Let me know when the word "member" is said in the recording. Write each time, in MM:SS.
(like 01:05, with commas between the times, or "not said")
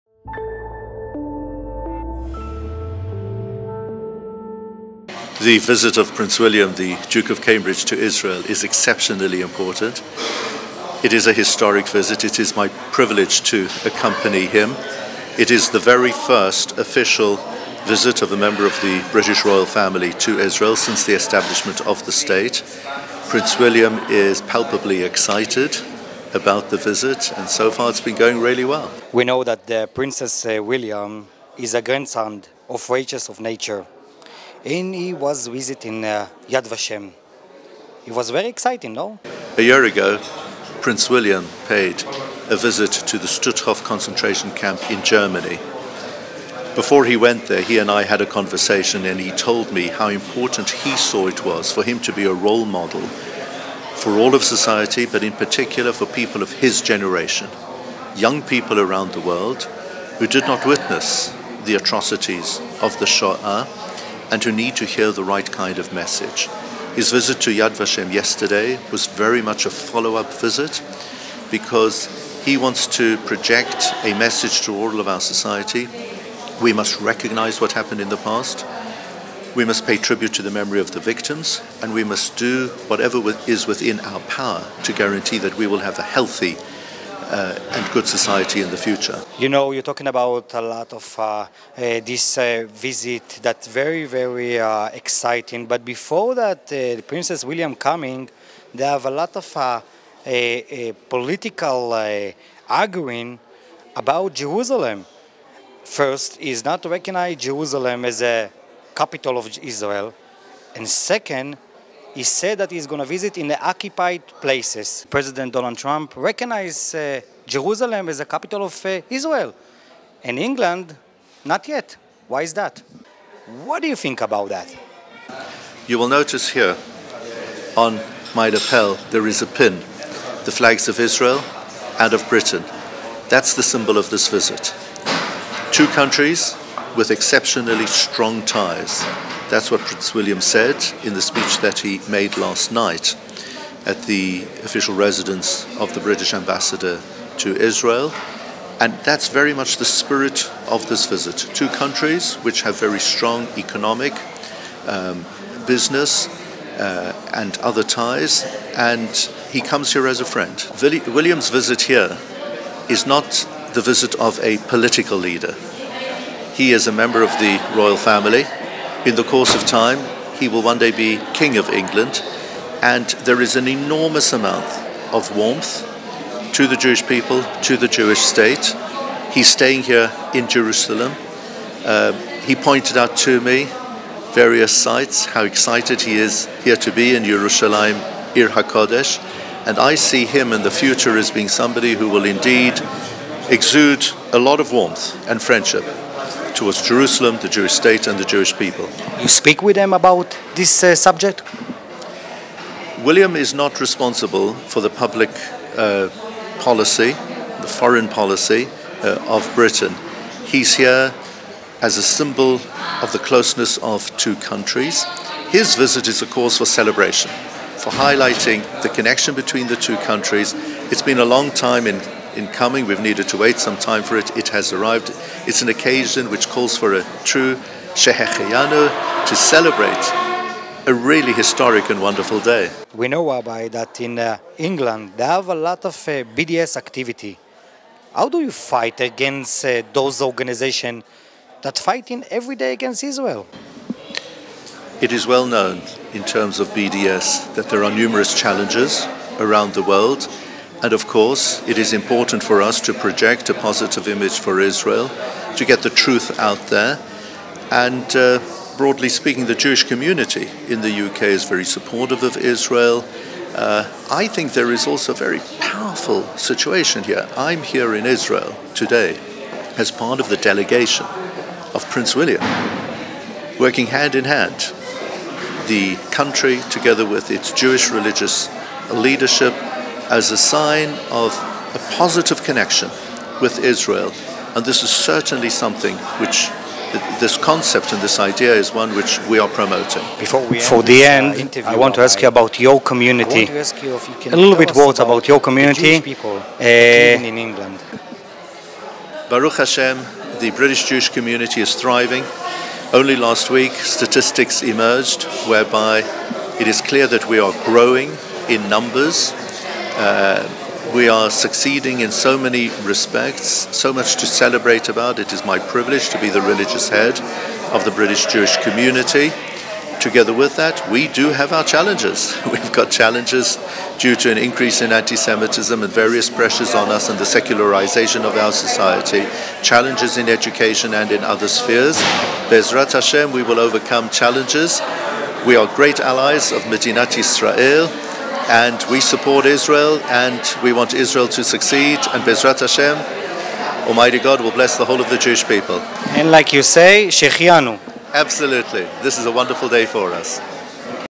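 00:18, 02:46.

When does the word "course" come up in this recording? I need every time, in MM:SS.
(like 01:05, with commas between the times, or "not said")
02:49, 04:11.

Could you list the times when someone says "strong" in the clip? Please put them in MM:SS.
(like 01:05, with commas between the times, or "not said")
02:17, 02:33.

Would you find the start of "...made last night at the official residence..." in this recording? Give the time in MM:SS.
02:22.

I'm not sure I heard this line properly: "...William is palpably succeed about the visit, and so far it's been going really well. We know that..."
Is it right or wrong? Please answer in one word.
wrong.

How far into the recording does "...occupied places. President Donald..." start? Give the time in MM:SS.
01:53.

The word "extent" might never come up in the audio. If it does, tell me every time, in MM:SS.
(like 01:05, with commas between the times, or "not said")
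not said.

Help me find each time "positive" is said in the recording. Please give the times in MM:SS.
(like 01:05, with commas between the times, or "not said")
04:13, 04:41.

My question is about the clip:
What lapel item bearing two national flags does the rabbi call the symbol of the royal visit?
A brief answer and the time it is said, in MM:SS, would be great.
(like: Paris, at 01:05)
a pin, at 02:09.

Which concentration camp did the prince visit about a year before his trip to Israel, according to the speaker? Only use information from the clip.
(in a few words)
Stutthof.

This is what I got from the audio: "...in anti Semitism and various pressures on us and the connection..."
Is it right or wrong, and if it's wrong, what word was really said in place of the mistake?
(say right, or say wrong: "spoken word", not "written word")
wrong: "secularization", not "connection".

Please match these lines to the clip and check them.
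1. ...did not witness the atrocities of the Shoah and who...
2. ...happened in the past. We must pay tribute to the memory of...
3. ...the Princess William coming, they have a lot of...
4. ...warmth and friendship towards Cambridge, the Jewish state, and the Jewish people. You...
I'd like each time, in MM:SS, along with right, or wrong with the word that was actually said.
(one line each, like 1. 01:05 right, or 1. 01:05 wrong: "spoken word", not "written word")
1. 01:00 right
2. 01:17 right
3. 01:36 right
4. 03:14 wrong: "Jerusalem", not "Cambridge".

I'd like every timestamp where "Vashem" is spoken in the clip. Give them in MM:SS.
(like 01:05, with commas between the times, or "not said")
00:36, 01:07.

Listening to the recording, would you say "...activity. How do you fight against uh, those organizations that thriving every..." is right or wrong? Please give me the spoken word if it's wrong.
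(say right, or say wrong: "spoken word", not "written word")
wrong: "fighting", not "thriving".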